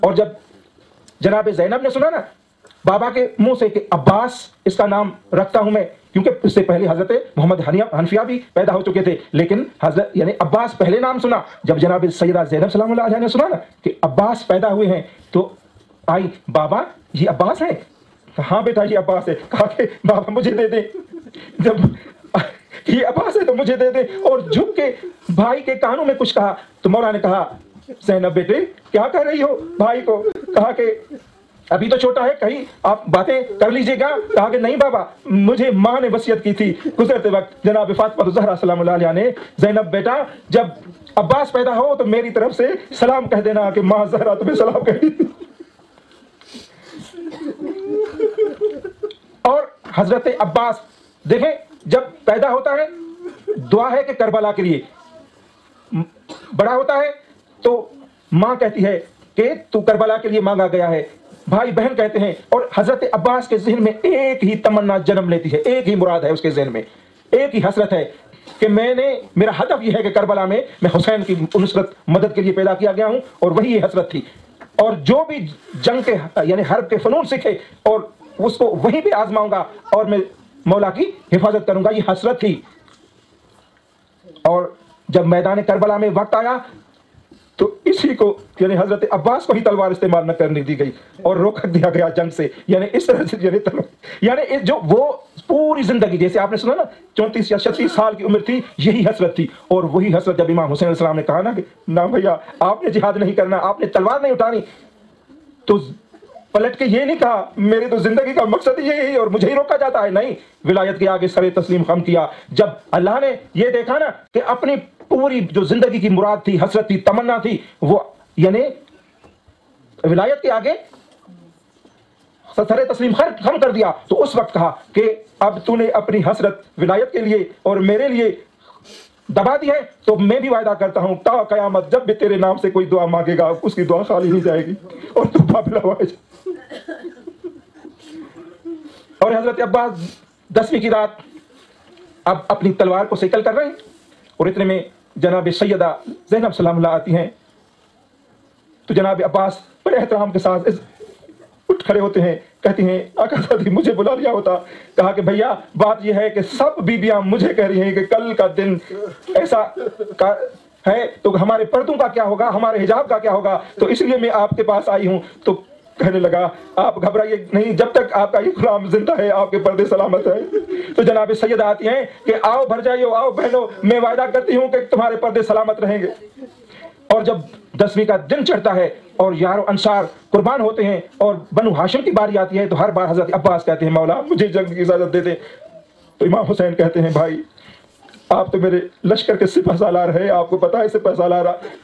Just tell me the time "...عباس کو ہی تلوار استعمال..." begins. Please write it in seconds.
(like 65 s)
89 s.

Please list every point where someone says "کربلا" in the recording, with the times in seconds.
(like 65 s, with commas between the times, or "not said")
54 s, 59 s, 70 s, 85 s.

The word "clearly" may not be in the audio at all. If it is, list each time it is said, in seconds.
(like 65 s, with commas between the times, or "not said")
not said.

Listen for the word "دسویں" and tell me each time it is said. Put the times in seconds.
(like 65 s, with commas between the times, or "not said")
140 s, 177 s.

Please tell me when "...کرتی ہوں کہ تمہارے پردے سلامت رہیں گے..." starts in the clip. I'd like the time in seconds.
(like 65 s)
174 s.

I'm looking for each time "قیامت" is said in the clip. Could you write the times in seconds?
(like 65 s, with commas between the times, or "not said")
131 s.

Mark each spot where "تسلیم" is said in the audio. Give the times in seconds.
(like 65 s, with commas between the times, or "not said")
111 s, 122 s.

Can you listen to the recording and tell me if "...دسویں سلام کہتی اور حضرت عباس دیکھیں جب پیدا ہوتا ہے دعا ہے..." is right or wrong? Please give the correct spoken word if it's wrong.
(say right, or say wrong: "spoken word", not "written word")
wrong: "تمہیں", not "دسویں".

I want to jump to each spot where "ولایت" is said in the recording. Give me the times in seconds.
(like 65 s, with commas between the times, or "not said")
110 s, 120 s, 126 s.